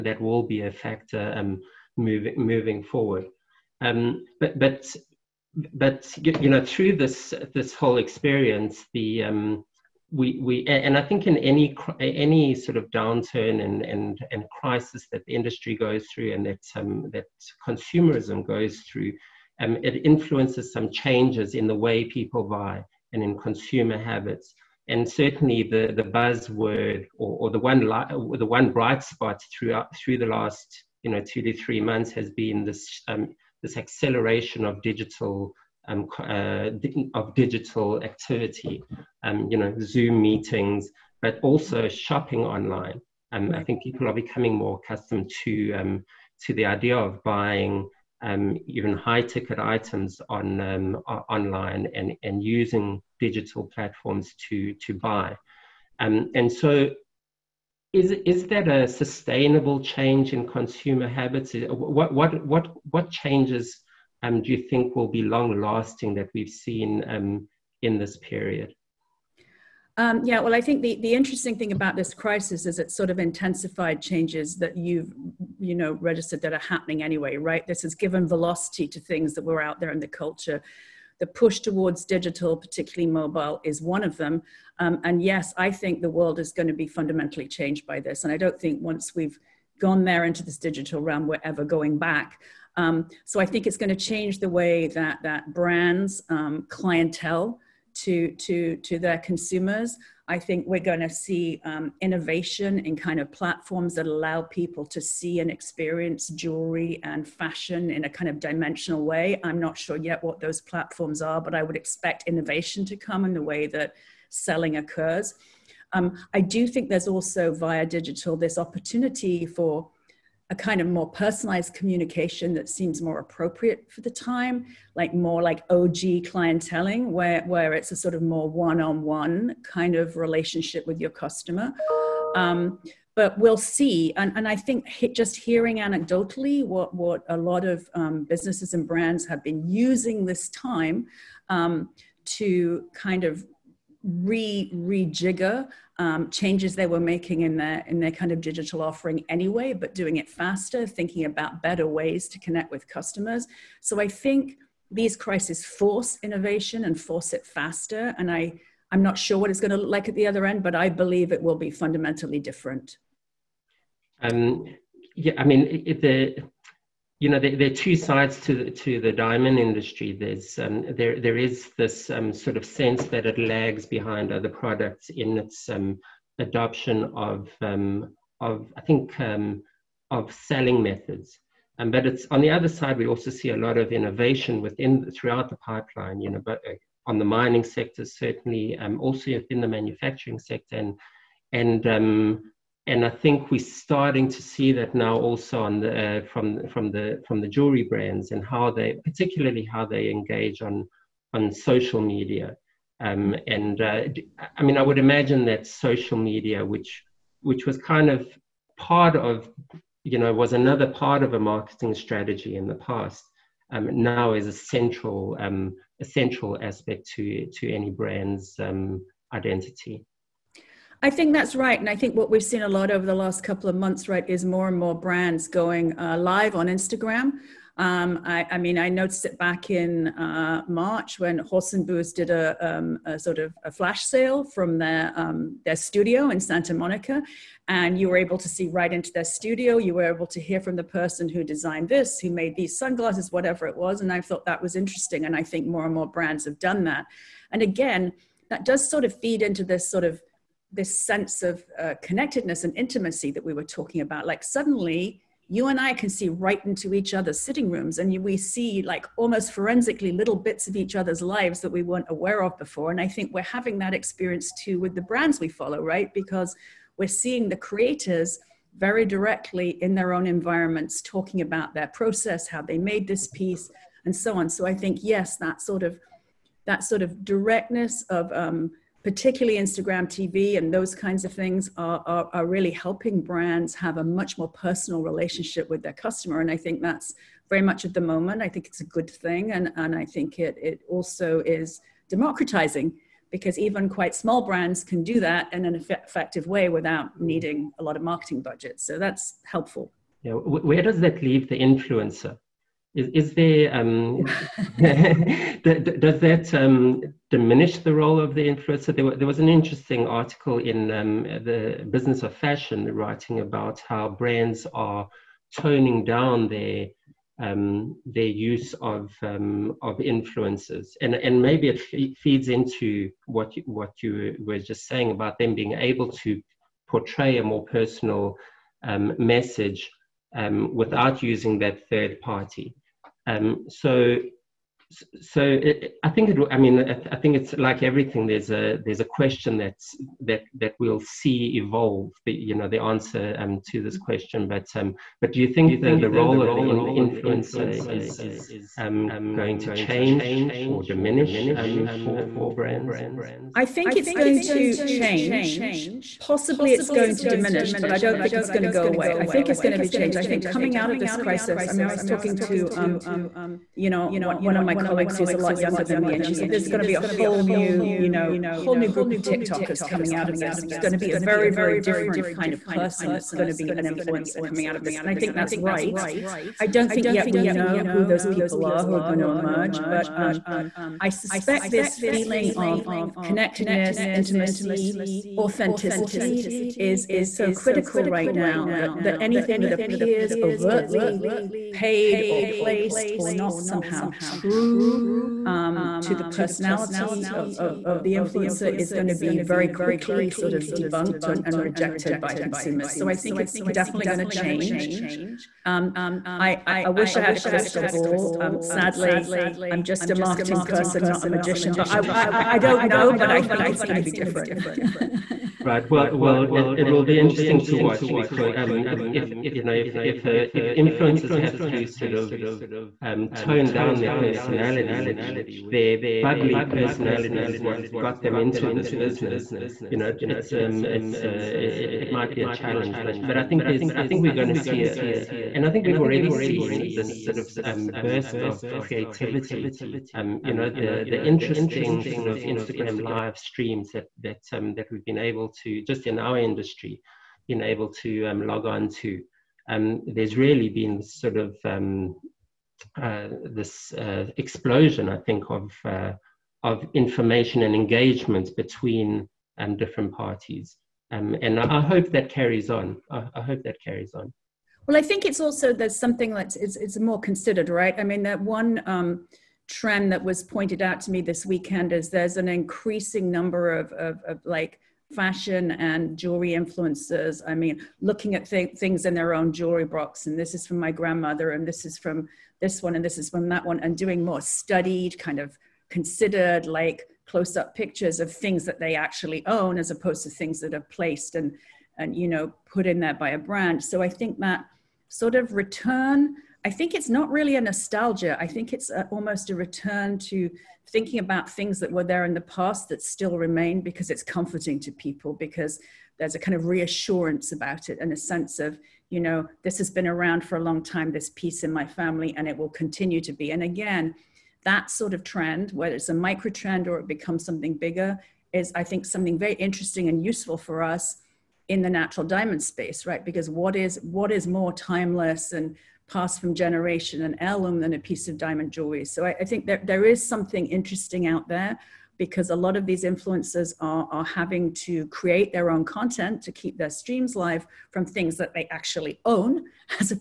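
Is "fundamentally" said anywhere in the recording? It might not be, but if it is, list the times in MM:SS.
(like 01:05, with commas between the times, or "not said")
01:26, 02:41.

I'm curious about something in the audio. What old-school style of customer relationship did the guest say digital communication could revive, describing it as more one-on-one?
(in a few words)
OG clienteling.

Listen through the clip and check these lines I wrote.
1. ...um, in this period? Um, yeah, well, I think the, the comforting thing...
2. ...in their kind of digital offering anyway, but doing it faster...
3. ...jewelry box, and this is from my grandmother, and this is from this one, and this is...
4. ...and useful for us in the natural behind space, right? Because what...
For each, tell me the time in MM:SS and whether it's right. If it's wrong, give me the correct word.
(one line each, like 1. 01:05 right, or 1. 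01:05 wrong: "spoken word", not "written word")
1. 01:07 wrong: "interesting", not "comforting"
2. 02:27 right
3. 07:59 right
4. 08:40 wrong: "diamond", not "behind".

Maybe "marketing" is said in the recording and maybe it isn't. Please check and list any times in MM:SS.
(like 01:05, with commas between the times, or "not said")
03:31, 04:58, 06:50.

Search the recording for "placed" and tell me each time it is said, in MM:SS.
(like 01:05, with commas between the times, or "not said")
06:32, 08:10.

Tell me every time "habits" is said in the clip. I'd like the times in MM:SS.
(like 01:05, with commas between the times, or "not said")
00:23, 01:01.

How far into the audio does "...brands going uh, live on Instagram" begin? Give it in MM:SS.
03:44.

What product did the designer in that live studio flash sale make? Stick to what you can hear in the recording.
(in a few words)
sunglasses.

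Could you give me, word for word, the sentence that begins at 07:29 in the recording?
Um, there's really been sort of um, uh, this uh, explosion, I think, of, uh, of information and engagement between different parties.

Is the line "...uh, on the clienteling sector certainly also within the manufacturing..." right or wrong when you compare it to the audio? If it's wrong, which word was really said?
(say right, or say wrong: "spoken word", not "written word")
wrong: "mining", not "clienteling".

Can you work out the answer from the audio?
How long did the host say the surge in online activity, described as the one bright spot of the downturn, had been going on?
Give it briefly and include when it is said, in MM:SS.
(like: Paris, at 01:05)
2 to 3 months, at 00:31.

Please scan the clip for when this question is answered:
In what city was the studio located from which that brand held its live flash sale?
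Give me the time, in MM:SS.
03:56.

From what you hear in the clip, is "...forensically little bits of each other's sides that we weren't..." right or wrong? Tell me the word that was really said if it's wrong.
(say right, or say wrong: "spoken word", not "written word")
wrong: "lives", not "sides".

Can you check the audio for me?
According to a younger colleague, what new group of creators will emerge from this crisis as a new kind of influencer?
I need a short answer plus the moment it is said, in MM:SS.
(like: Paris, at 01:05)
TikTokers, at 06:09.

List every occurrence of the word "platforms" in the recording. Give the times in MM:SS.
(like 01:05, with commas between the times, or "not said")
00:53, 01:43, 01:50.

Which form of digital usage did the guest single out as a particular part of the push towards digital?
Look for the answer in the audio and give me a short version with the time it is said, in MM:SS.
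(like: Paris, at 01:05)
mobile, at 01:23.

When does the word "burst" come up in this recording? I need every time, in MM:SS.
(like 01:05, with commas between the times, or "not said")
07:18.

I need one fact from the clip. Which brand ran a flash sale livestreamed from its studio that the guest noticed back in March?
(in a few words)
Horse and Booze.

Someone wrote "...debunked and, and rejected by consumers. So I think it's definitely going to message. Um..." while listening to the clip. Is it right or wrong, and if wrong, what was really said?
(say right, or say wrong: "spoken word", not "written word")
wrong: "change", not "message".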